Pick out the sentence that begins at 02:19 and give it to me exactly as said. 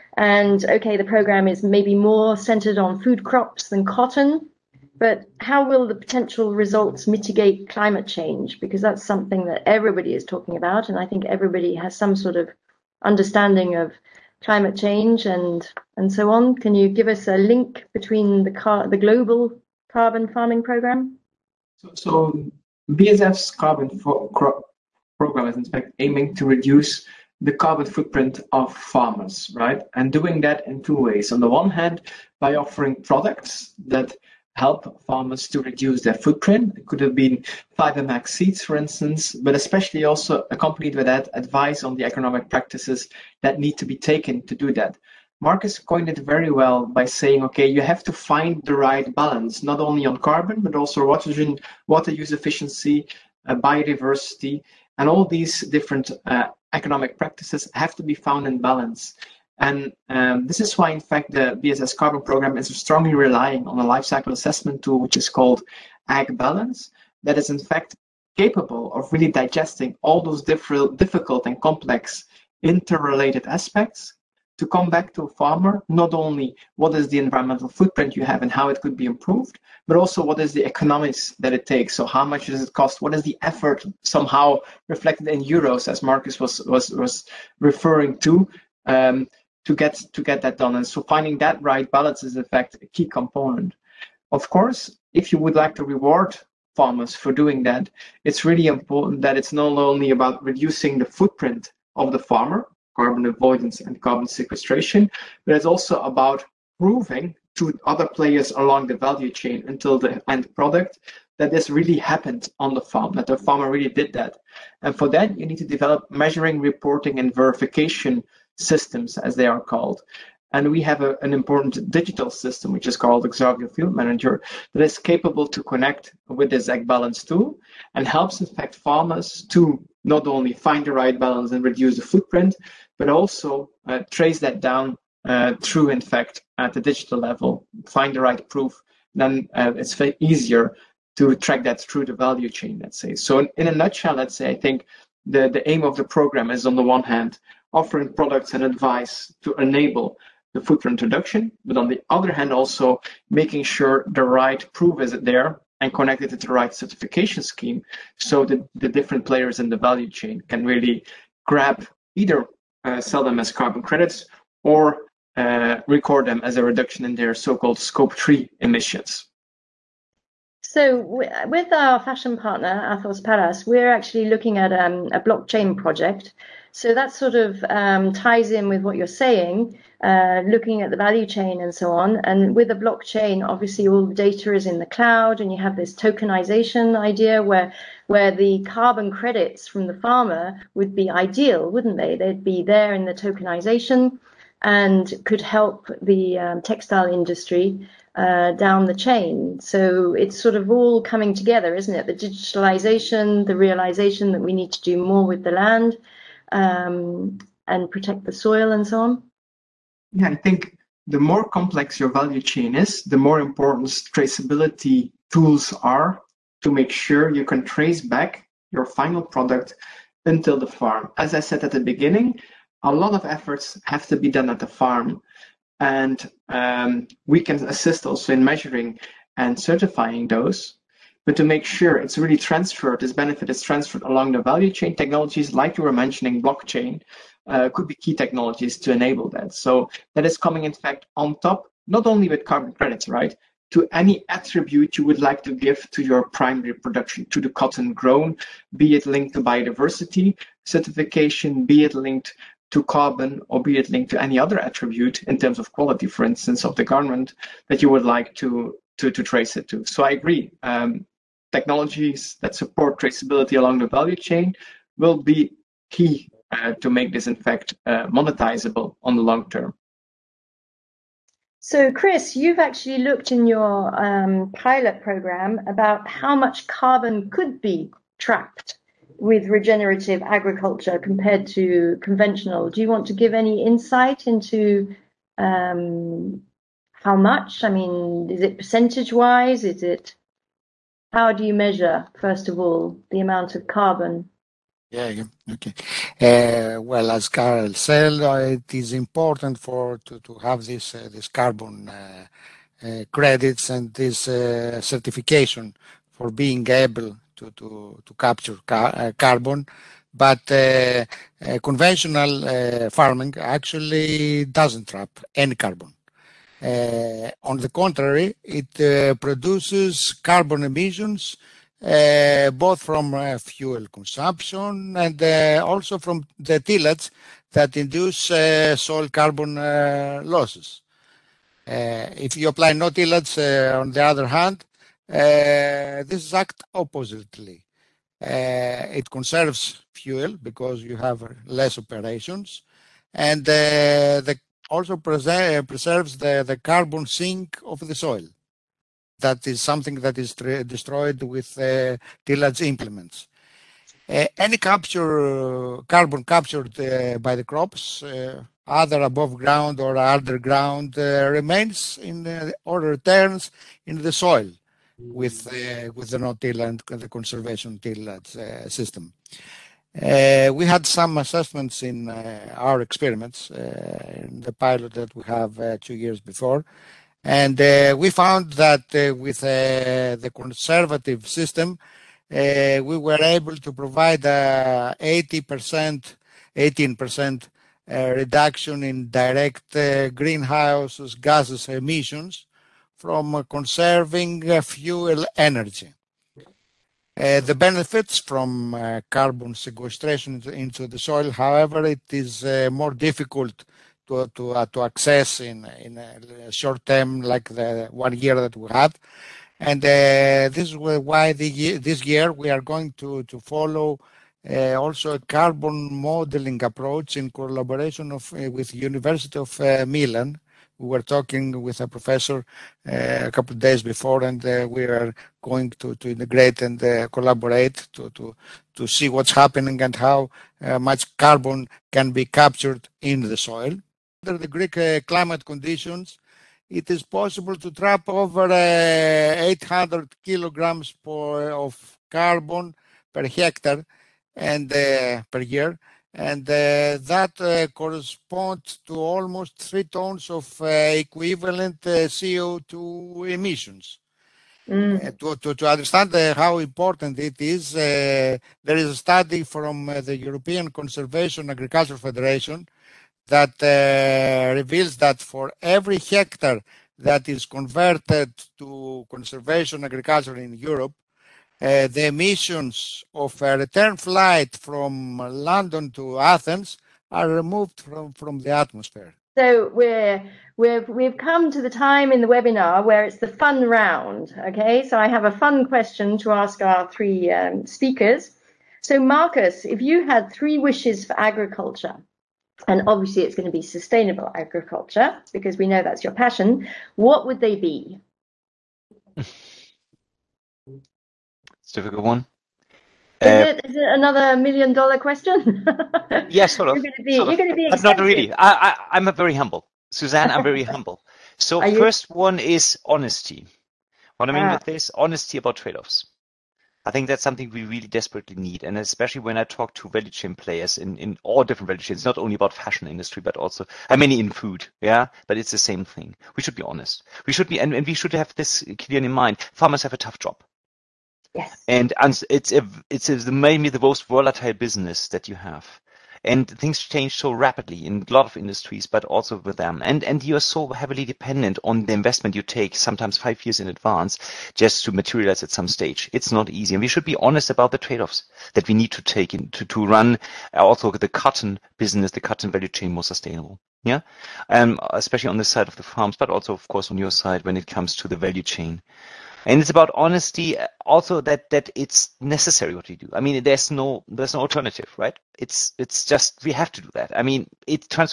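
Then uh, it's easier to track that through the value chain, let's say.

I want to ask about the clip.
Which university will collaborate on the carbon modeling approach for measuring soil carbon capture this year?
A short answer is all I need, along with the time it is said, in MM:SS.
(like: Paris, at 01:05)
University of Milan, at 06:58.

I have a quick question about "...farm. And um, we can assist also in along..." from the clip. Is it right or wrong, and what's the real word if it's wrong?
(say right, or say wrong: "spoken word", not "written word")
wrong: "measuring", not "along".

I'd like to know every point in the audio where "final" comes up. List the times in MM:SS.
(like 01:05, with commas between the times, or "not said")
03:38.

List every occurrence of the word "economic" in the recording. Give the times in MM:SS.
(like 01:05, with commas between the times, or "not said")
00:42, 00:56, 01:20.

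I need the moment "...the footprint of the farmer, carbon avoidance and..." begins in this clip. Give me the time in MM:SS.
01:40.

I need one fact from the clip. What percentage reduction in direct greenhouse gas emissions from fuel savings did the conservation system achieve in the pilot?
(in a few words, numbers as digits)
18%.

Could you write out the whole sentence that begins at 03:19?
So it's sort of all coming together, isn't it?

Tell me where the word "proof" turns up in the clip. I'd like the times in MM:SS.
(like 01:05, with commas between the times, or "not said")
02:18, 02:34.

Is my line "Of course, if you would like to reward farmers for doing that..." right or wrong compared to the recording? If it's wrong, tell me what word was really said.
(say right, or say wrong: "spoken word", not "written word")
right.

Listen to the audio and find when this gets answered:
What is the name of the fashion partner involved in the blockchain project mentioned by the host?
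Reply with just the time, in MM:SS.
02:52.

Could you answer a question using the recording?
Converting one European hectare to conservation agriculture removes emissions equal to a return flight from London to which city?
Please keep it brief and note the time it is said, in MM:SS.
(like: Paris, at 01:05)
Athens, at 07:56.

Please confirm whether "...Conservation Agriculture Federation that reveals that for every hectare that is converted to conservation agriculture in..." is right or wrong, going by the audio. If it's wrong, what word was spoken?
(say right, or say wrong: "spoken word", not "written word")
right.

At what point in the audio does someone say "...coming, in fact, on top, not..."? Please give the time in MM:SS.
04:00.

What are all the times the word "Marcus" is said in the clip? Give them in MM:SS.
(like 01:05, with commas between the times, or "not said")
00:45, 01:26, 08:08.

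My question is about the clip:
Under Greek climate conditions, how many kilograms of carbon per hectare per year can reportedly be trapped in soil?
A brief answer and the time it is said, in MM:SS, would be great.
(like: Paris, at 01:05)
800, at 07:19.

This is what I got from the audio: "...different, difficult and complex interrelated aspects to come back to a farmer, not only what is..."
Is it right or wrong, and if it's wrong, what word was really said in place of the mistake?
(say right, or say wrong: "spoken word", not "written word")
right.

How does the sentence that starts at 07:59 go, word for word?
So we're, we've, we've come to the time in the webinar where it's the fun round.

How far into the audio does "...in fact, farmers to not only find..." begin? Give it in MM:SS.
02:08.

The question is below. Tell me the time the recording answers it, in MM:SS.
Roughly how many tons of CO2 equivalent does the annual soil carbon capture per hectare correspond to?
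07:29.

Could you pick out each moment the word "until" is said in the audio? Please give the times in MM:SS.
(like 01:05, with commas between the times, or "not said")
01:49, 03:40.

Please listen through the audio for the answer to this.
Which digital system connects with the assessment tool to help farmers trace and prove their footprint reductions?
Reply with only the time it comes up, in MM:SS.
02:03.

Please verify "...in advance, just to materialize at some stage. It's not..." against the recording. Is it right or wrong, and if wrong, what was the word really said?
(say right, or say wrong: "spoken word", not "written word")
right.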